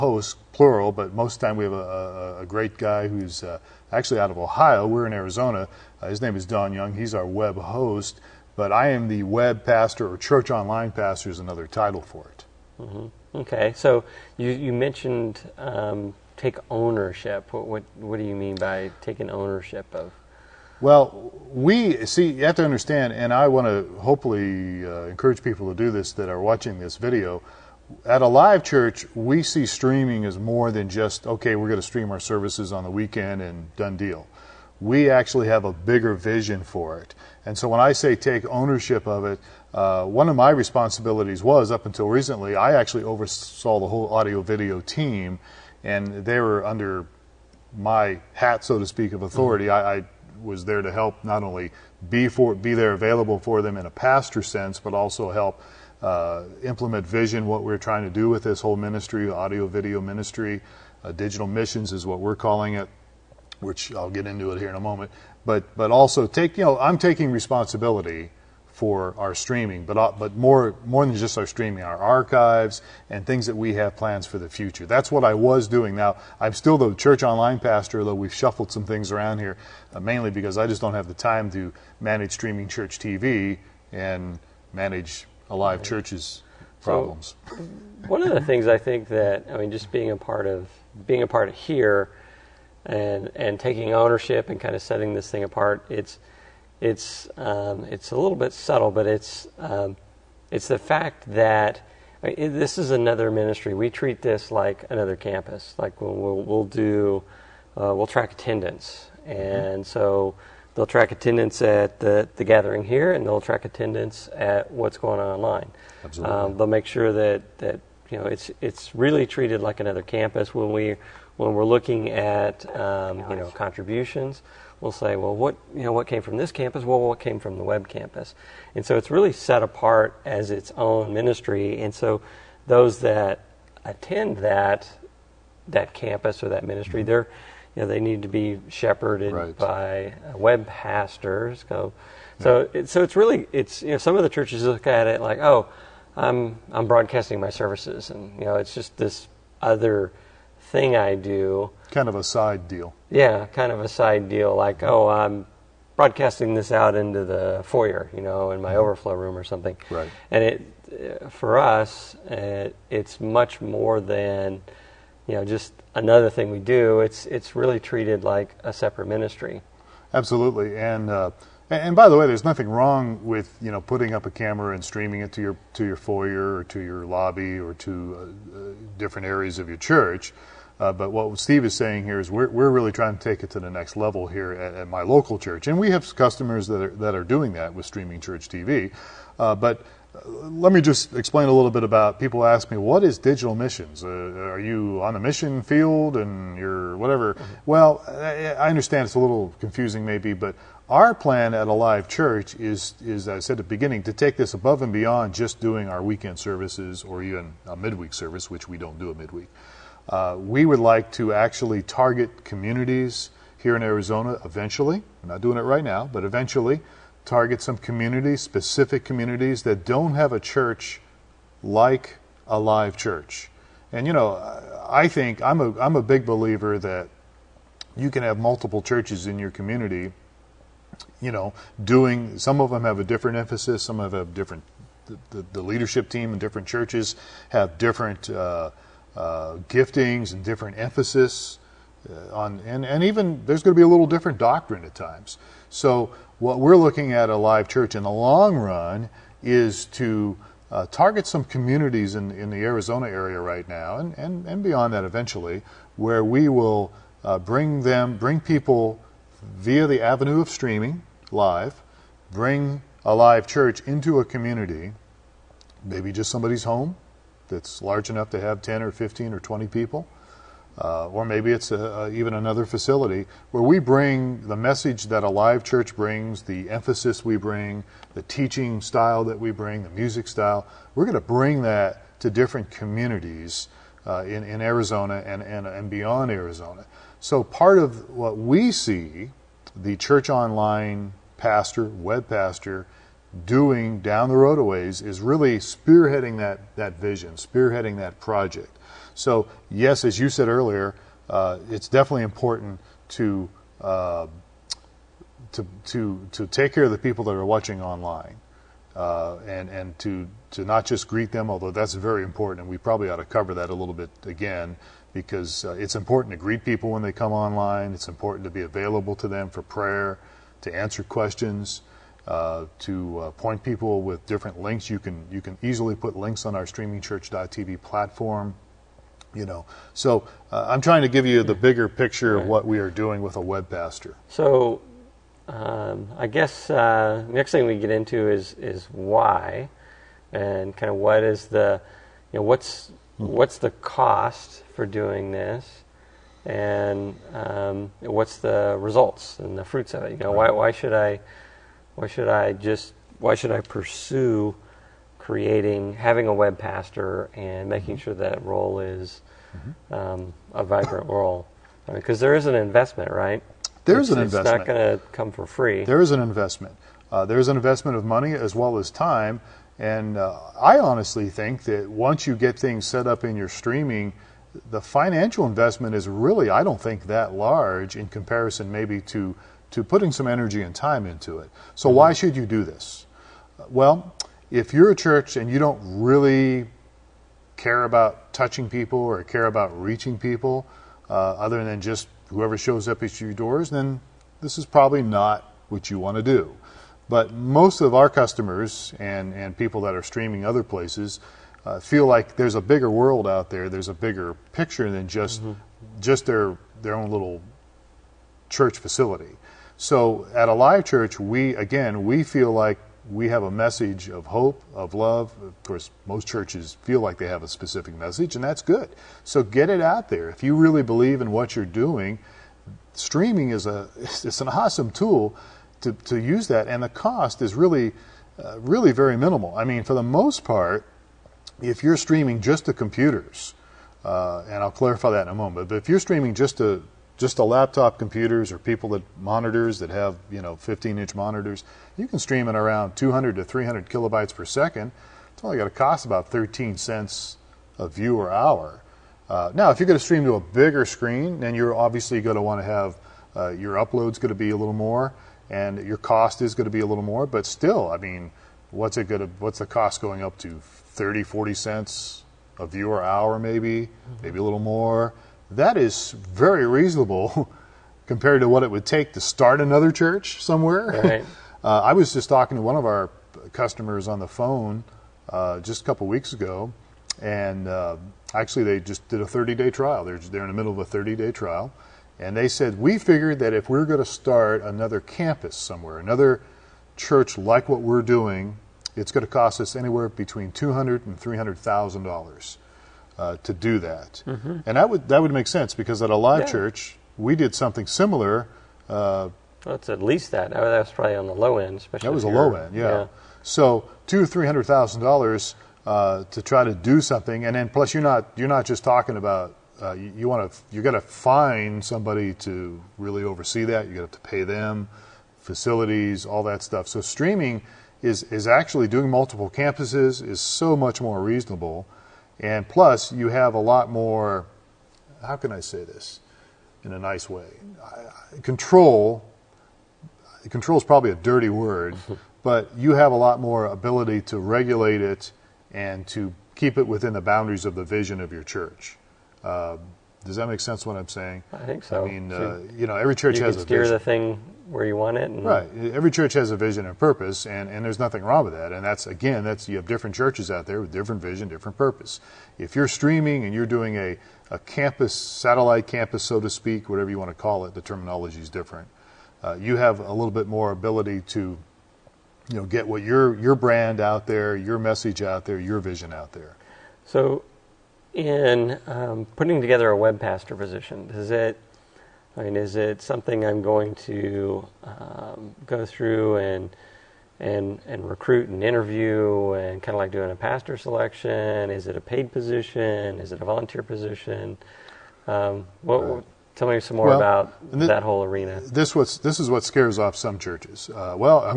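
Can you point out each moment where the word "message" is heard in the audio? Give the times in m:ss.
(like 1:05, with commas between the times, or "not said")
4:34, 6:53, 6:57, 9:24.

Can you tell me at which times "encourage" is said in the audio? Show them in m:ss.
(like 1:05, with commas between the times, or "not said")
0:25.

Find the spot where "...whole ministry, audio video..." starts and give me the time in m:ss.
0:58.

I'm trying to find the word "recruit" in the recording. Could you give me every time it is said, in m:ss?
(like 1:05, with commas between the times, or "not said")
9:38.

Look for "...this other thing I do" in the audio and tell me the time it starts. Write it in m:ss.
2:28.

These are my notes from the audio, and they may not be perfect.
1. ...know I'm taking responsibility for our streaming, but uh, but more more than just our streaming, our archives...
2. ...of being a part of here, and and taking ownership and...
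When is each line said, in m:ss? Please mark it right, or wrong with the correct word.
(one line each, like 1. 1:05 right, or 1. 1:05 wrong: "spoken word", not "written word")
1. 1:06 right
2. 1:30 right.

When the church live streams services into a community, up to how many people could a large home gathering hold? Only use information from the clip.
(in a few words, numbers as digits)
20.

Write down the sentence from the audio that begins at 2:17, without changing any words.
they're you know, they need to be shepherded right.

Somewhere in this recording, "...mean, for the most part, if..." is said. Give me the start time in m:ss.
7:09.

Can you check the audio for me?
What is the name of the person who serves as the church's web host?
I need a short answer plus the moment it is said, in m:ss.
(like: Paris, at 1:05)
Don Young, at 0:06.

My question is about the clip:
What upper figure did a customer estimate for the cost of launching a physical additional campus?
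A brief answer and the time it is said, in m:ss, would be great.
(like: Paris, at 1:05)
$300,000, at 8:12.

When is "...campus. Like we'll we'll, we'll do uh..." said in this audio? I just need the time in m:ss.
1:45.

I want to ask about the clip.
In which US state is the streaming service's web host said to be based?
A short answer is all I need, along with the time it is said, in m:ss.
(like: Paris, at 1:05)
Ohio, at 0:04.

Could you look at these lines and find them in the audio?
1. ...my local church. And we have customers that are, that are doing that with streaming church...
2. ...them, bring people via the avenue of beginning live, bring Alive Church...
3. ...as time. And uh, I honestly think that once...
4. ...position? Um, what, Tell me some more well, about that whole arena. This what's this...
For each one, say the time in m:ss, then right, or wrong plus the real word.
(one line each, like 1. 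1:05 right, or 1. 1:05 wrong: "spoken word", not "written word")
1. 3:04 right
2. 4:17 wrong: "streaming", not "beginning"
3. 6:08 right
4. 9:43 right.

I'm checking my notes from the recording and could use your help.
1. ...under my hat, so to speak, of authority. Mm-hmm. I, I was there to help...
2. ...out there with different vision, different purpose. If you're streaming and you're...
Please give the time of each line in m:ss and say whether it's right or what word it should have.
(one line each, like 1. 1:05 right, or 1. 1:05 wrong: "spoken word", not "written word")
1. 0:46 right
2. 9:10 right.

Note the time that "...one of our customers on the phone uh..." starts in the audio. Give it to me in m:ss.
7:52.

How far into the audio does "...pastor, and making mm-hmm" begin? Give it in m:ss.
5:56.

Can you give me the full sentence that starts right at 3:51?
You know, doing some of them have a different emphasis, some of them have different.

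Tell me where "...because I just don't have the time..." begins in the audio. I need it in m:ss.
1:20.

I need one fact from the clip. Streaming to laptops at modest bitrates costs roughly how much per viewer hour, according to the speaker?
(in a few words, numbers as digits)
13 cents.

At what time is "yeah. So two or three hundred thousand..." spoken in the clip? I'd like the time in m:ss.
8:22.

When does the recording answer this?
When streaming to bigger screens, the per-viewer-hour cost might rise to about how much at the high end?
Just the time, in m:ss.
7:41.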